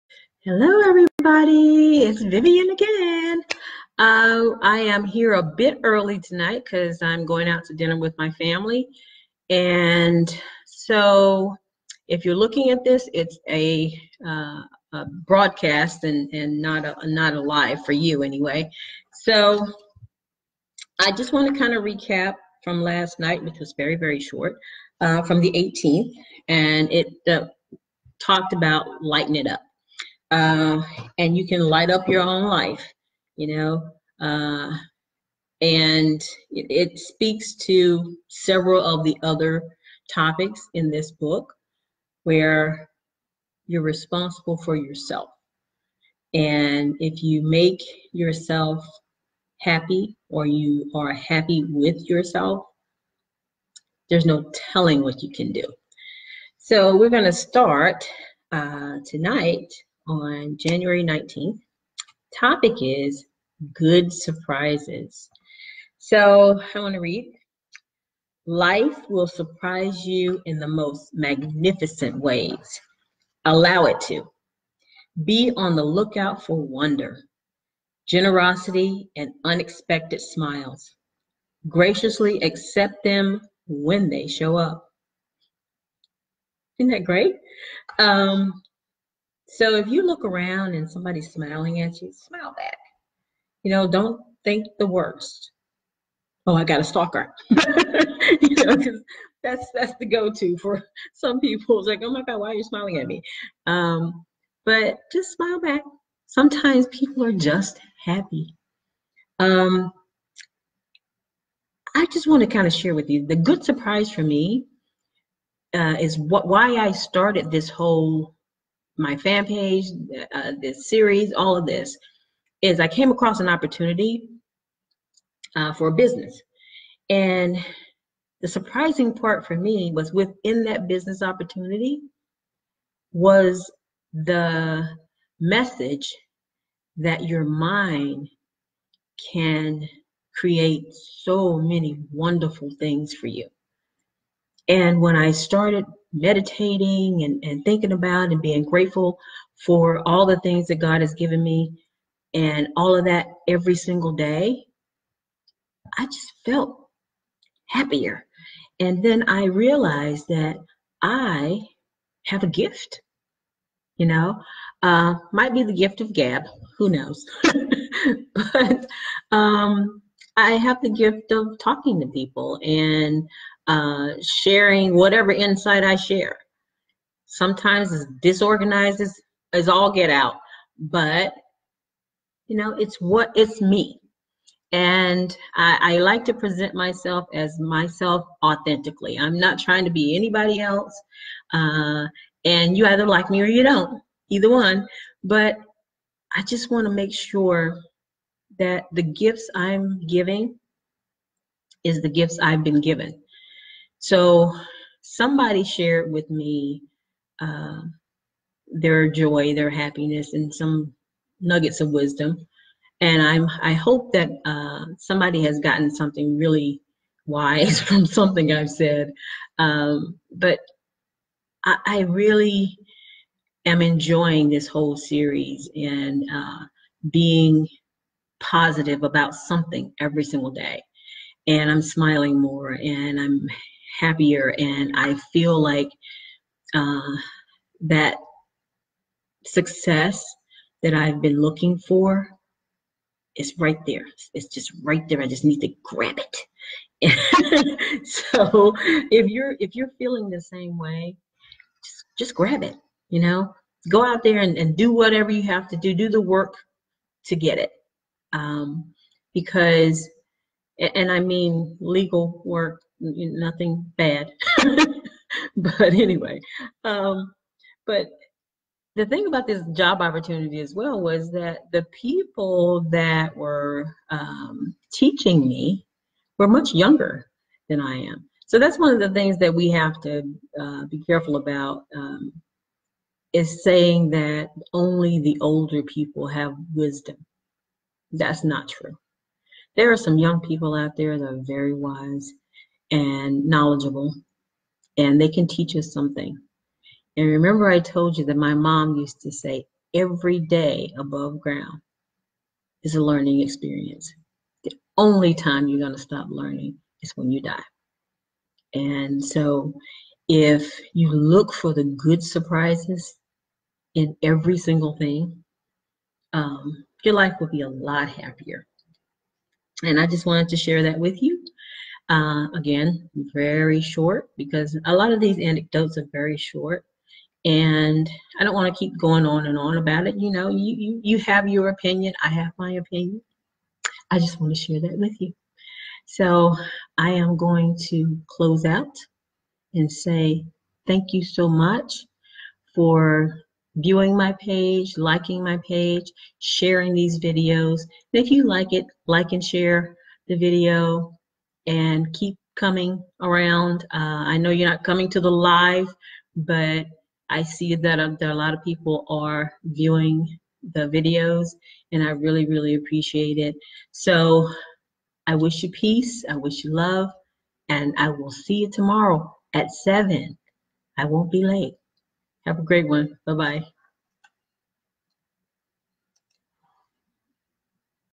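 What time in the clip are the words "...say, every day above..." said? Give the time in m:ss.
4:59.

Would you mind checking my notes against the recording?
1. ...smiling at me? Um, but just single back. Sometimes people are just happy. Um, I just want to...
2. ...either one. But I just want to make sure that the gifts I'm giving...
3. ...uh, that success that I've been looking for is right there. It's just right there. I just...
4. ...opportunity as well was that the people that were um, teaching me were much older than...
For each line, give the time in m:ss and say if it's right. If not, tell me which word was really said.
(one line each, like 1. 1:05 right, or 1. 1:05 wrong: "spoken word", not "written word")
1. 1:42 wrong: "smile", not "single"
2. 3:14 right
3. 3:56 right
4. 4:30 wrong: "younger", not "older".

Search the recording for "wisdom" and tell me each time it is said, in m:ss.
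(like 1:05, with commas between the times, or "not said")
3:31, 4:46.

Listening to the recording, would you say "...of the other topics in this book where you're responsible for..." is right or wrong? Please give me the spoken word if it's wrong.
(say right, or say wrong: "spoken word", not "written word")
right.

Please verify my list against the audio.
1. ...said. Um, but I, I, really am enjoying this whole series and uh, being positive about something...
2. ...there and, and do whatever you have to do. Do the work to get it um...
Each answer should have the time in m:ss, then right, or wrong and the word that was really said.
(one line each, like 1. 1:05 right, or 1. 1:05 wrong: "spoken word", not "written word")
1. 3:38 right
2. 4:14 right.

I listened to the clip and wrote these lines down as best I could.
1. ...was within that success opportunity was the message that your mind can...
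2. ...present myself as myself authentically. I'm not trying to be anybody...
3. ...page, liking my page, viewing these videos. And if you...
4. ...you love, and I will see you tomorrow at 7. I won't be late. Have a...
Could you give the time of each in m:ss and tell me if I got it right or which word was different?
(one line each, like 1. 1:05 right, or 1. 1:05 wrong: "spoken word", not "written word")
1. 2:09 wrong: "business", not "success"
2. 3:06 right
3. 5:44 wrong: "sharing", not "viewing"
4. 6:06 right.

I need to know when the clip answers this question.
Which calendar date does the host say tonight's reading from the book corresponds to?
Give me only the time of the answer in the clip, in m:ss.
1:00.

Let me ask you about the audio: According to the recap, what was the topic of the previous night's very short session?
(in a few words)
Lighten it up.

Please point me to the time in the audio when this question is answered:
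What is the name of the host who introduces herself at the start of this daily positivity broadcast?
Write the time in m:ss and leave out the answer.
0:02.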